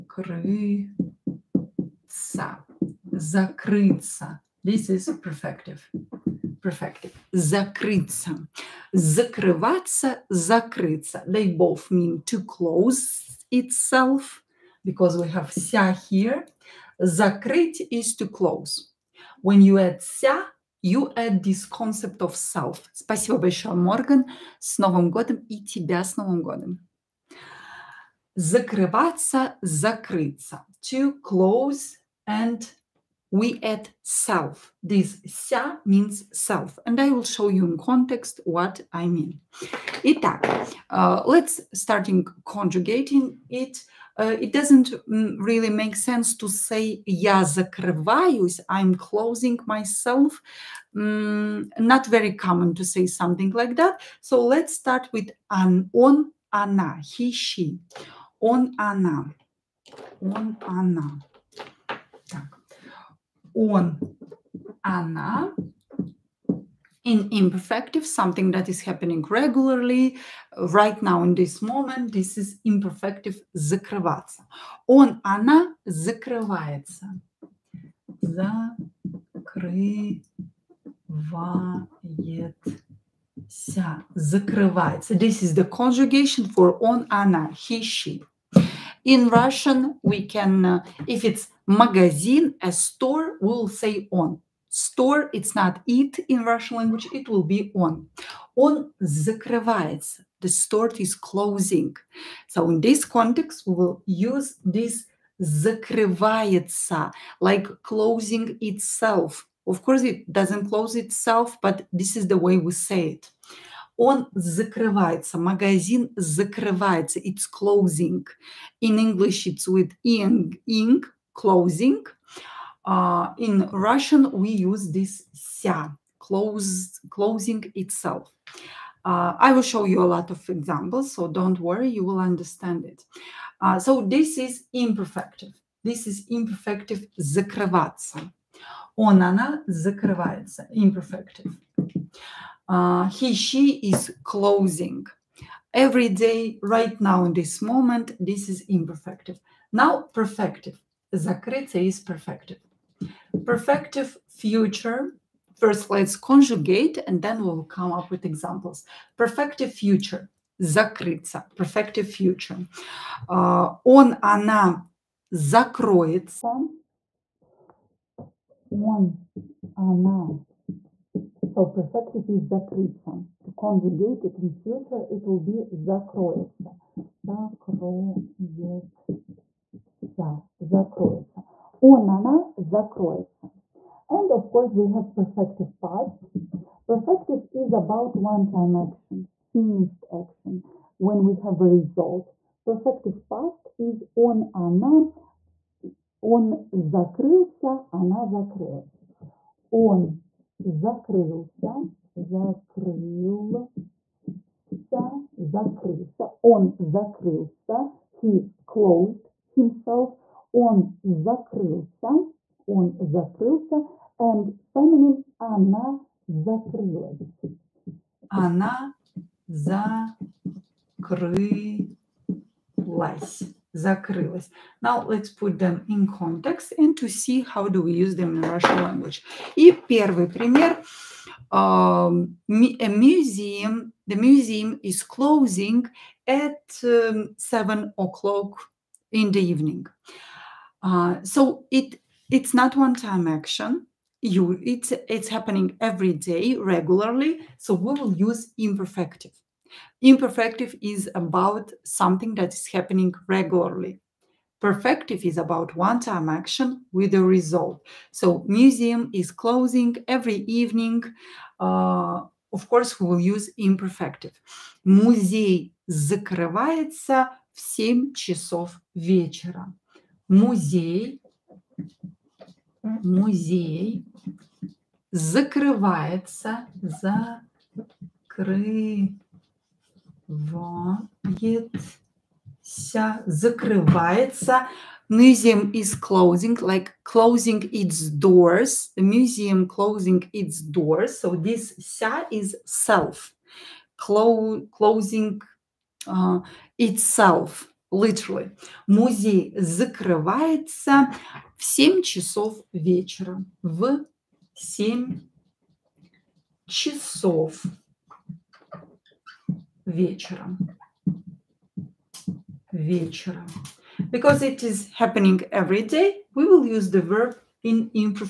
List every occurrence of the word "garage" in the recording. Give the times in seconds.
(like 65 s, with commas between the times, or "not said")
not said.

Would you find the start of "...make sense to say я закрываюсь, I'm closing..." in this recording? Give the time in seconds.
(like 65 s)
45 s.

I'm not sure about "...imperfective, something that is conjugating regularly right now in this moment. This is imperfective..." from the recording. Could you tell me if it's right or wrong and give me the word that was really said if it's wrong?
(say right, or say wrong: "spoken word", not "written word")
wrong: "happening", not "conjugating".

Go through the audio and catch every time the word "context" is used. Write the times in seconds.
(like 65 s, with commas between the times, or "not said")
37 s, 103 s, 226 s.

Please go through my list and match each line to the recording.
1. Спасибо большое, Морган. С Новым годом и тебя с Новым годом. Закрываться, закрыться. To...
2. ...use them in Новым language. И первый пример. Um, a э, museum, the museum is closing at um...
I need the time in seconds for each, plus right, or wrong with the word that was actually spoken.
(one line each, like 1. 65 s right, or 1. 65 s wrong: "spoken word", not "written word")
1. 22 s right
2. 227 s wrong: "Russian", not "Новым".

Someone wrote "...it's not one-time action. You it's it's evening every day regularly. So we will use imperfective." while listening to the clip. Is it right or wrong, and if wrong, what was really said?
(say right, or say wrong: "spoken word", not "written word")
wrong: "happening", not "evening".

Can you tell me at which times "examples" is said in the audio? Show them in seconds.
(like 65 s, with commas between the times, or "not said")
130 s, 158 s.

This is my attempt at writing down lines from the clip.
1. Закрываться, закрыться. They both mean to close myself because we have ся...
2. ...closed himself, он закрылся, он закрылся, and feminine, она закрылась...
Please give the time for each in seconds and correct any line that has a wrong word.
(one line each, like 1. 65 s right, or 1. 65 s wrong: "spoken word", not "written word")
1. 8 s wrong: "itself", not "myself"
2. 208 s right.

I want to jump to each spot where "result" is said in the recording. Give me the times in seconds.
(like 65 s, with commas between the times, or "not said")
191 s, 257 s.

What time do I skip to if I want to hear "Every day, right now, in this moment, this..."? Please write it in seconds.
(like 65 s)
145 s.